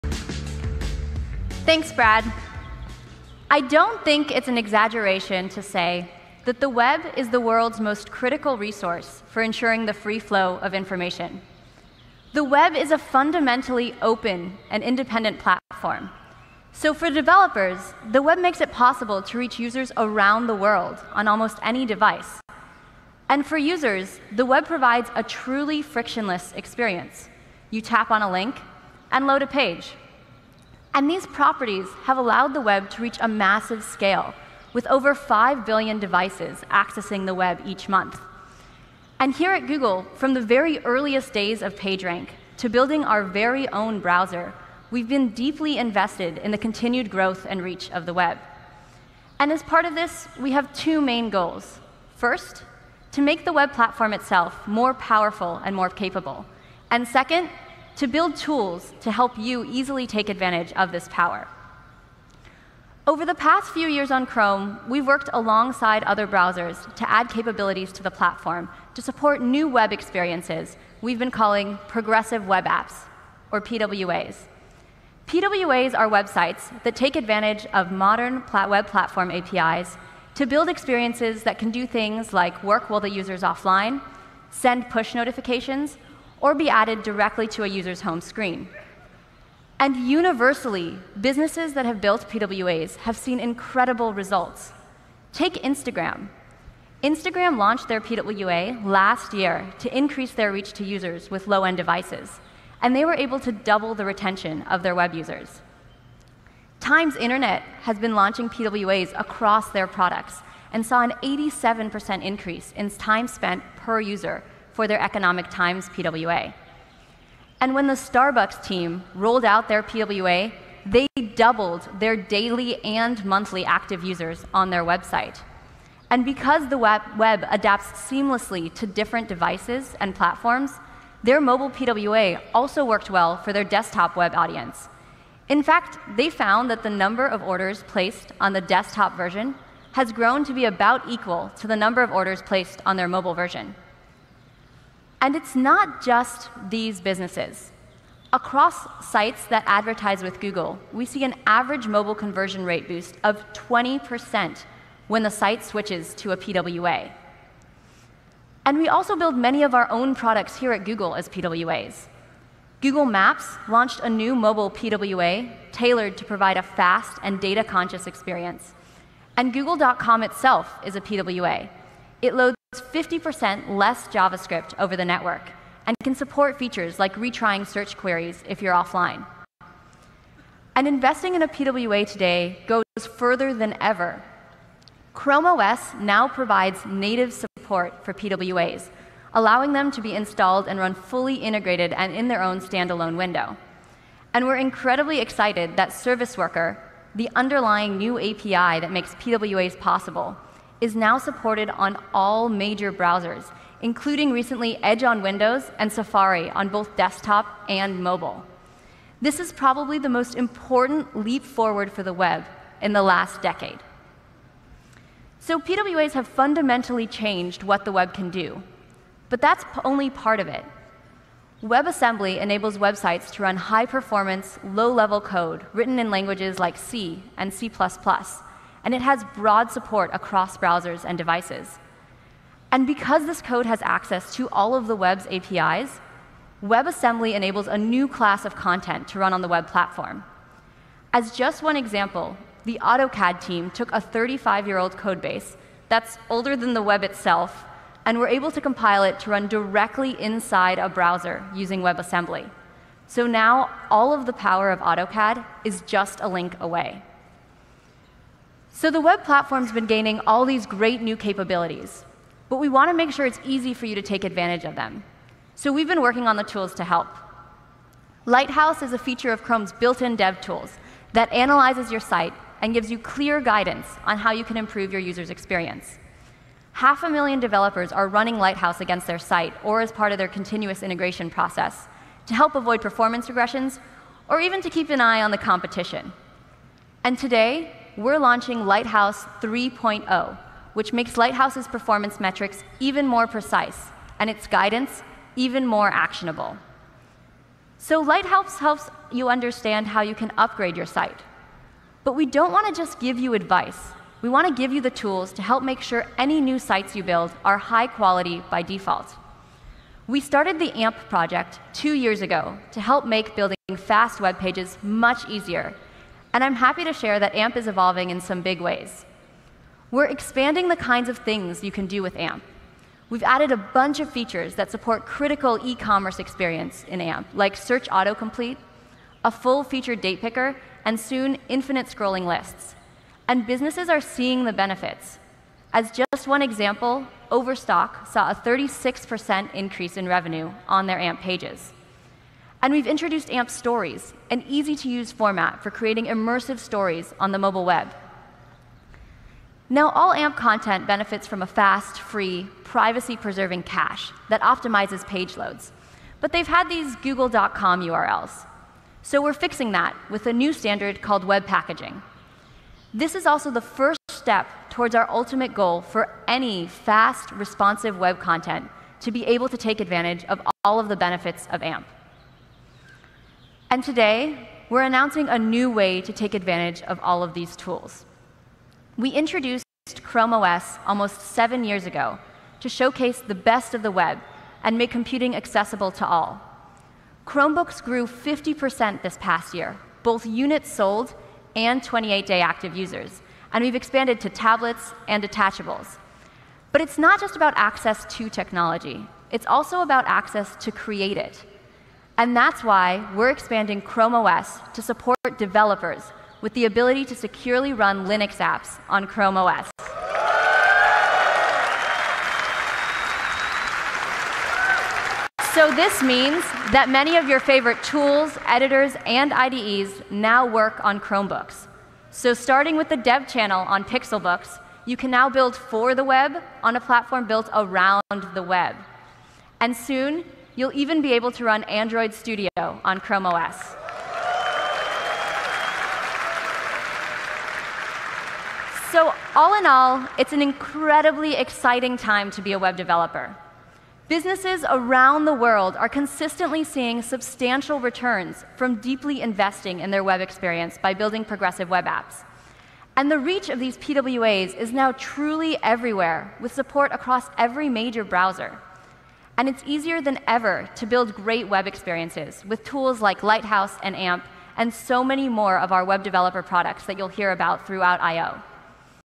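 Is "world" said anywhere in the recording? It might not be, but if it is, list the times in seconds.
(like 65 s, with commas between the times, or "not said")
7 s, 20 s, 445 s.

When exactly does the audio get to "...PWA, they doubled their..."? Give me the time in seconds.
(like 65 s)
119 s.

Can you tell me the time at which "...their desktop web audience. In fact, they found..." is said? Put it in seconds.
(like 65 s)
133 s.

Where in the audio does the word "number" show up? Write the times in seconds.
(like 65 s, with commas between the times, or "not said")
136 s, 141 s.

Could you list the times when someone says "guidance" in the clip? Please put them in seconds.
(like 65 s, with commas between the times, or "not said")
273 s, 294 s.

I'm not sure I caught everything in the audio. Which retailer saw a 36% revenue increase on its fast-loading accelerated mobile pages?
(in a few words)
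Overstock.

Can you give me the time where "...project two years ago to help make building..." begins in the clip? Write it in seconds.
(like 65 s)
311 s.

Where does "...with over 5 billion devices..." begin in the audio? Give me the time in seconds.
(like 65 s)
34 s.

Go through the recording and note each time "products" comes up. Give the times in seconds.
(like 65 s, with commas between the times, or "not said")
109 s, 160 s, 466 s.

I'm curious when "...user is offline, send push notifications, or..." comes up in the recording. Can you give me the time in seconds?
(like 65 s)
83 s.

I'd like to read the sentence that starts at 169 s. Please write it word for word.
And Google.com itself is a PWA.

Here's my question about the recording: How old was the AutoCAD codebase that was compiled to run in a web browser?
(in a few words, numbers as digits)
35 years.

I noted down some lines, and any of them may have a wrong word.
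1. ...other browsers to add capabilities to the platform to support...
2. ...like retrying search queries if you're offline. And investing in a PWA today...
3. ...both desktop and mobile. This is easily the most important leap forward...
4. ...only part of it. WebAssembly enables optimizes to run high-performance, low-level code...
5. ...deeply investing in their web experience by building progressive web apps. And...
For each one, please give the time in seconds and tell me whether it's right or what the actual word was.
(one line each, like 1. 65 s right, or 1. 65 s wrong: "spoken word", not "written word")
1. 66 s right
2. 176 s right
3. 206 s wrong: "probably", not "easily"
4. 219 s wrong: "websites", not "optimizes"
5. 448 s right.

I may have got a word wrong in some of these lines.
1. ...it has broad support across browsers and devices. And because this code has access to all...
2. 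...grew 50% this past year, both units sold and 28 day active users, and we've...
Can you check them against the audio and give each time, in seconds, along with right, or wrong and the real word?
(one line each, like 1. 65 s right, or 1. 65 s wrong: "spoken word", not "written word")
1. 228 s right
2. 387 s right.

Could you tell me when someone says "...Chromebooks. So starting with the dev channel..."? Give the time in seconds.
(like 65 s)
420 s.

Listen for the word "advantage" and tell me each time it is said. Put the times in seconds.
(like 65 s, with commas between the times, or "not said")
60 s, 77 s, 264 s, 369 s, 376 s.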